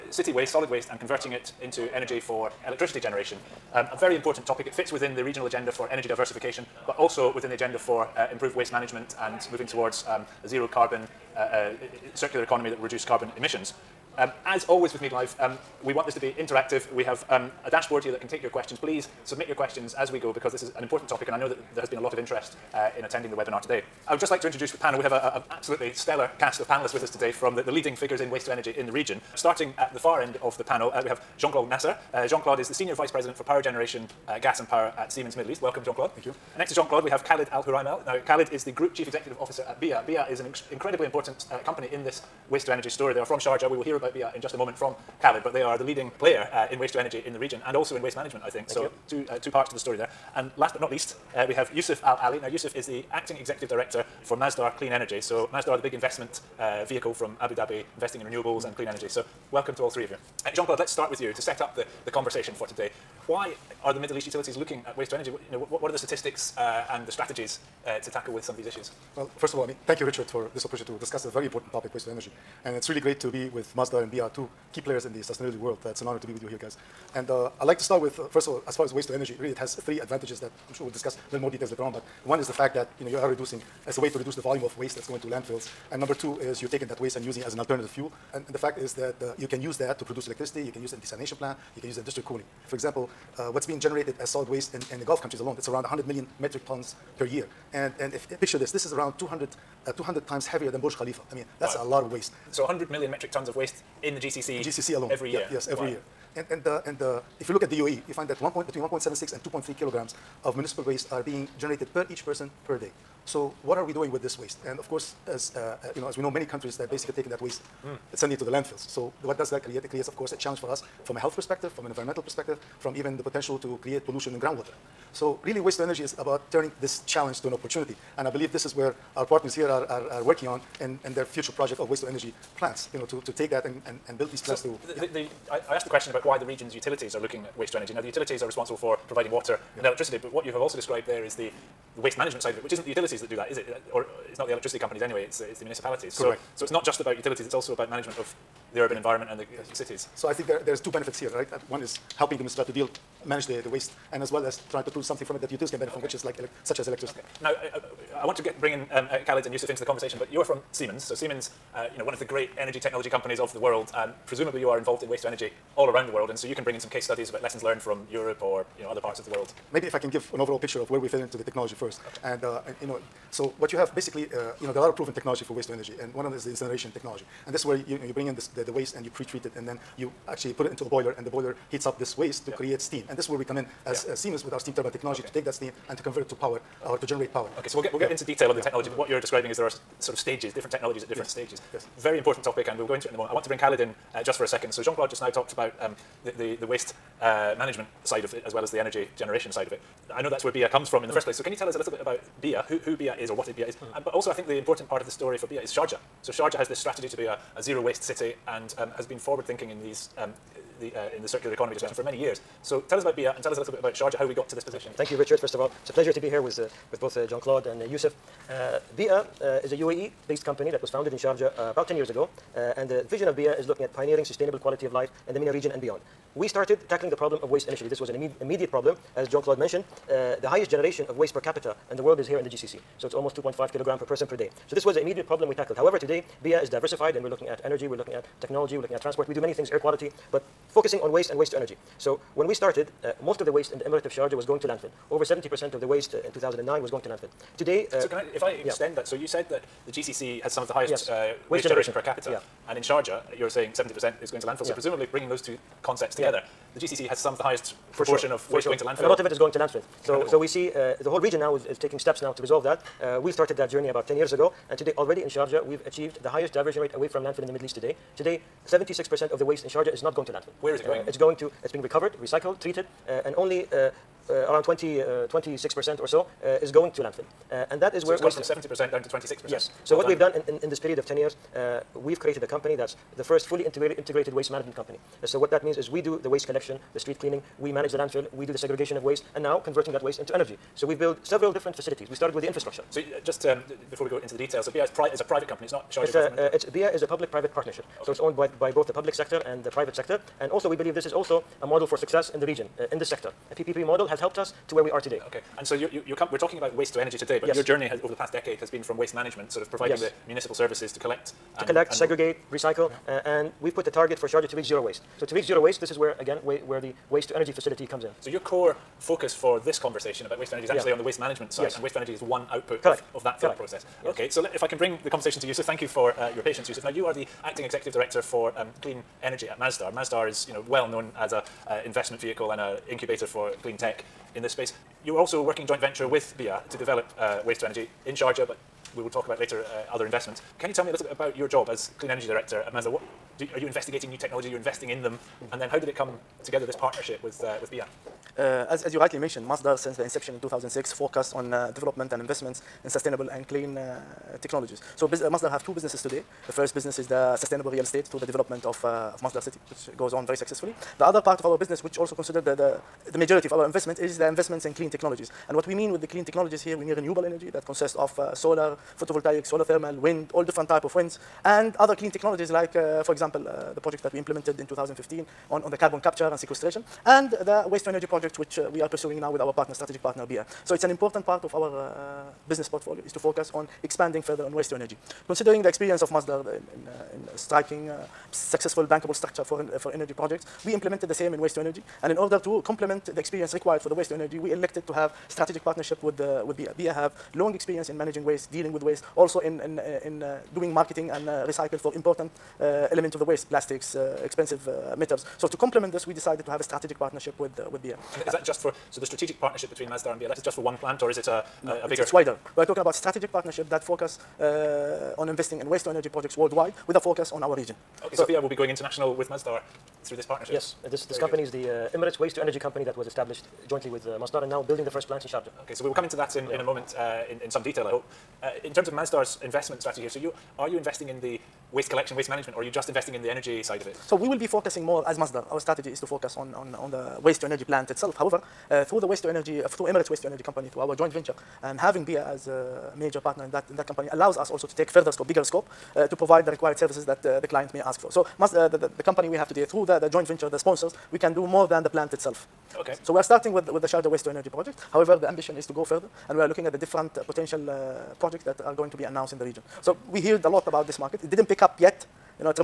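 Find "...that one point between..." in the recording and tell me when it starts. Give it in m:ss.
1:48.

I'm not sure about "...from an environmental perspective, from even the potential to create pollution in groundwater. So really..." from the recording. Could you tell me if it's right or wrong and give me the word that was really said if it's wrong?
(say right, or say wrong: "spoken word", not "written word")
right.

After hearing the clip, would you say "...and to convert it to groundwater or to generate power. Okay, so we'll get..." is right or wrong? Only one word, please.
wrong.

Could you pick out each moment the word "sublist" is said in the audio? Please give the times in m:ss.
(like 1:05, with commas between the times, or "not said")
not said.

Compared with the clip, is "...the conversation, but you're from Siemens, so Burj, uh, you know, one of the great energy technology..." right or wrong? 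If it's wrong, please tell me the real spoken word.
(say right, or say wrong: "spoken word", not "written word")
wrong: "Siemens", not "Burj".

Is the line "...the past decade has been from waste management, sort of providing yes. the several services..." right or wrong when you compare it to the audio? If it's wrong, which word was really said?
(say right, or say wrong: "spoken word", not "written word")
wrong: "municipal", not "several".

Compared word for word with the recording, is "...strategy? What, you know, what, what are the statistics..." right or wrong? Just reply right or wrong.
wrong.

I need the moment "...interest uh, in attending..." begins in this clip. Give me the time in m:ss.
0:22.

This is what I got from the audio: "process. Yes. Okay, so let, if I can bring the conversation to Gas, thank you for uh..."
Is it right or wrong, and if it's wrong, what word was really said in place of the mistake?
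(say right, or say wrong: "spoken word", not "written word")
wrong: "Yousif", not "Gas".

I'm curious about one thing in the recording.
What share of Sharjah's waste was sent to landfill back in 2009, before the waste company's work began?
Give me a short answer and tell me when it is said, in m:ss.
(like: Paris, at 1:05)
over 70%, at 4:05.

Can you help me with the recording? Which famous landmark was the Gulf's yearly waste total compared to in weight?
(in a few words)
Burj Khalifa.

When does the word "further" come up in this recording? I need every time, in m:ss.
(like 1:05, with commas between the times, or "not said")
6:24, 7:24, 7:35.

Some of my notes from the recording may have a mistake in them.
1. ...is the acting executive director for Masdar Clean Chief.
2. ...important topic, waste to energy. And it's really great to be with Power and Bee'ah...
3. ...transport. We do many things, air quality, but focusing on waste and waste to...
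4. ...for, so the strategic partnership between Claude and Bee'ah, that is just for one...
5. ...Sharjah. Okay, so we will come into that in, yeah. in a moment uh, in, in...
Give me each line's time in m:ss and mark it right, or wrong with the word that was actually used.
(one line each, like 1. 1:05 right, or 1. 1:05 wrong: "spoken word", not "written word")
1. 0:52 wrong: "Energy", not "Chief"
2. 1:11 wrong: "Masdar", not "Power"
3. 3:59 right
4. 6:48 wrong: "Masdar", not "Claude"
5. 7:05 right.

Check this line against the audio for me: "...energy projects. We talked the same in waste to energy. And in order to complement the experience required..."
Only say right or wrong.
wrong.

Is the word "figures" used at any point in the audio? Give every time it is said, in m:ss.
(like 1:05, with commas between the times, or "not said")
0:27.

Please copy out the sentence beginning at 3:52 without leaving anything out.
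So it's almost 2.5 kilogram per person per day.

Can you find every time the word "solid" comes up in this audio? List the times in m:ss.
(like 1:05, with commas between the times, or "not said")
0:00, 1:34.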